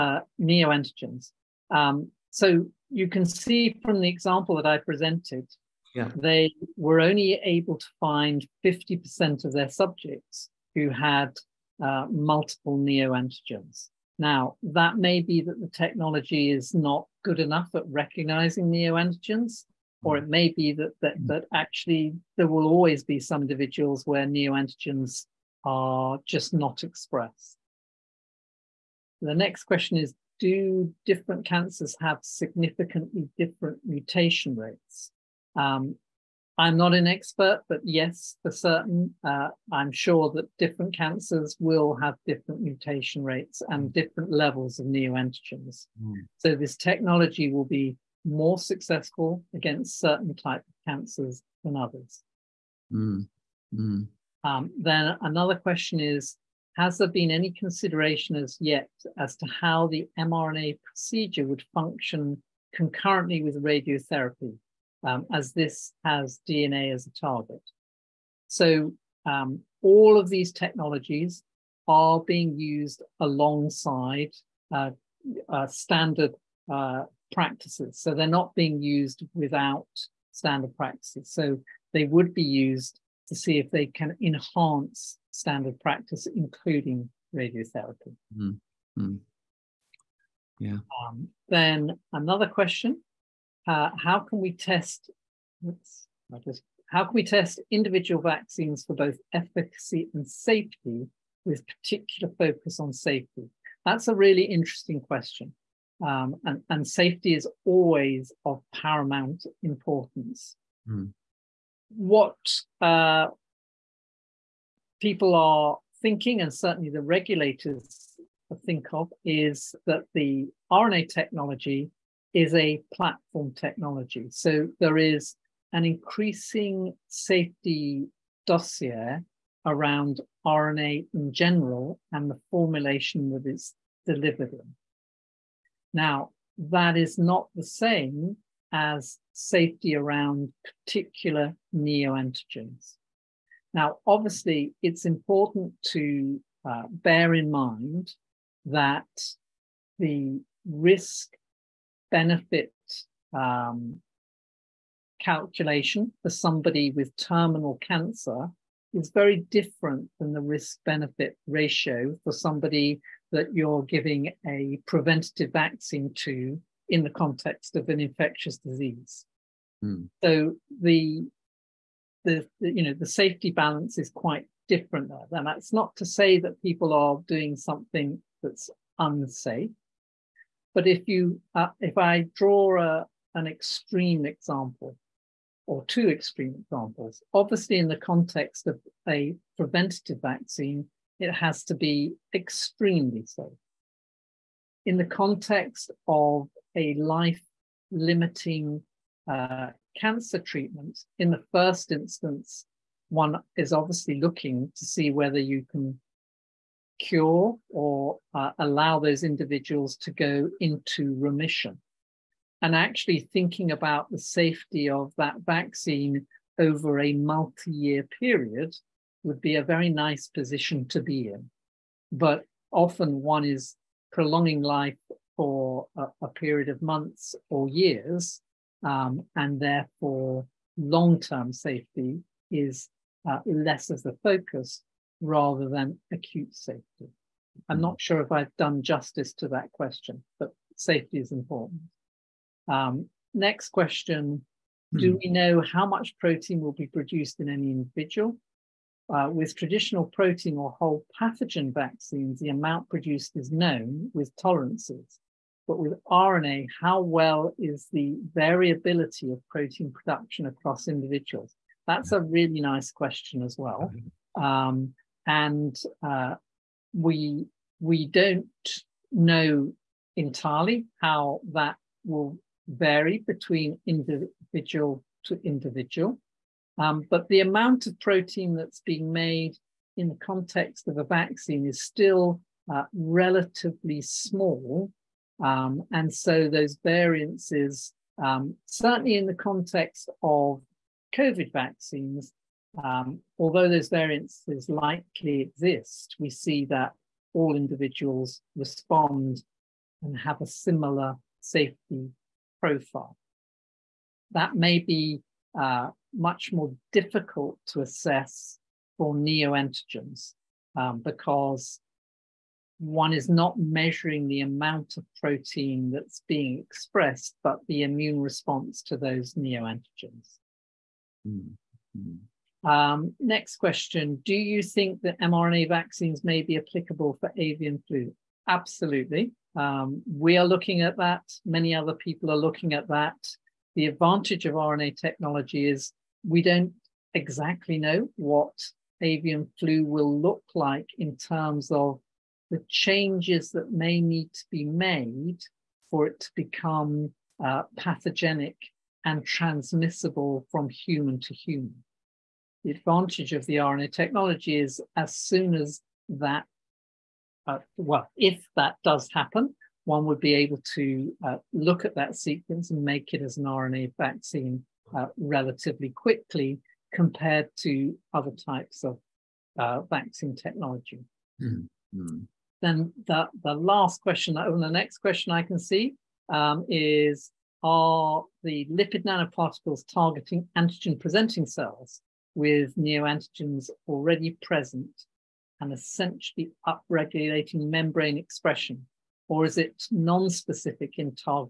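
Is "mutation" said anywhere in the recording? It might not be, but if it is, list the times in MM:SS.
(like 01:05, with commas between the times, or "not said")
00:33, 00:42.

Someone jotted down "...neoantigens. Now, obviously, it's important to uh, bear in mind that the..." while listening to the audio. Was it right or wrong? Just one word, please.
right.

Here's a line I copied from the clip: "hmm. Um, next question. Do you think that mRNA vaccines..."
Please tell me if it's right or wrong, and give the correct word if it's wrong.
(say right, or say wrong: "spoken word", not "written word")
right.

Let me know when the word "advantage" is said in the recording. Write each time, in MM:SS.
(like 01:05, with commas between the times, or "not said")
05:33, 05:52.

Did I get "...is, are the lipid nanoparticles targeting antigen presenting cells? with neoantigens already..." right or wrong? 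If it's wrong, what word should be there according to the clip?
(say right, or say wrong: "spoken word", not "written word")
right.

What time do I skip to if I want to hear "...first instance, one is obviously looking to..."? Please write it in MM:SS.
03:21.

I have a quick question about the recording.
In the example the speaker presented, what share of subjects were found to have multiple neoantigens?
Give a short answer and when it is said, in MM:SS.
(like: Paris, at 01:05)
50%, at 00:08.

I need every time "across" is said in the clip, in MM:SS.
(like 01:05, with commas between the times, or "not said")
04:20.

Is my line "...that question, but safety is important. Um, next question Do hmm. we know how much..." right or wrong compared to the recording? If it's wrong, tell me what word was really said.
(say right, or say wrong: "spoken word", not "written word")
right.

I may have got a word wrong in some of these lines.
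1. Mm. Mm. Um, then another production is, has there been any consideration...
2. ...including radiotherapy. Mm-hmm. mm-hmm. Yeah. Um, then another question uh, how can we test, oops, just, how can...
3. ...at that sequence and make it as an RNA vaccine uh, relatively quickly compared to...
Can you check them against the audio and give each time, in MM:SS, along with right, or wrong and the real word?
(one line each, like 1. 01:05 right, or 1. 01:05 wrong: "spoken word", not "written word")
1. 00:52 wrong: "question", not "production"
2. 01:26 right
3. 06:01 right.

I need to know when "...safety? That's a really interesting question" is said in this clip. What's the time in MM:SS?
01:42.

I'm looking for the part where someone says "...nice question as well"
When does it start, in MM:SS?
04:22.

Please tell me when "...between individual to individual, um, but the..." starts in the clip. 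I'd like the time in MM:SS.
04:33.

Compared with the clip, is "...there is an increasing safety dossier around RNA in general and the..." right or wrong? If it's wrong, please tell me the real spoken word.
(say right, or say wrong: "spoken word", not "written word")
right.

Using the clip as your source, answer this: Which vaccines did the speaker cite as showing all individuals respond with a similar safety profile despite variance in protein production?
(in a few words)
COVID vaccines.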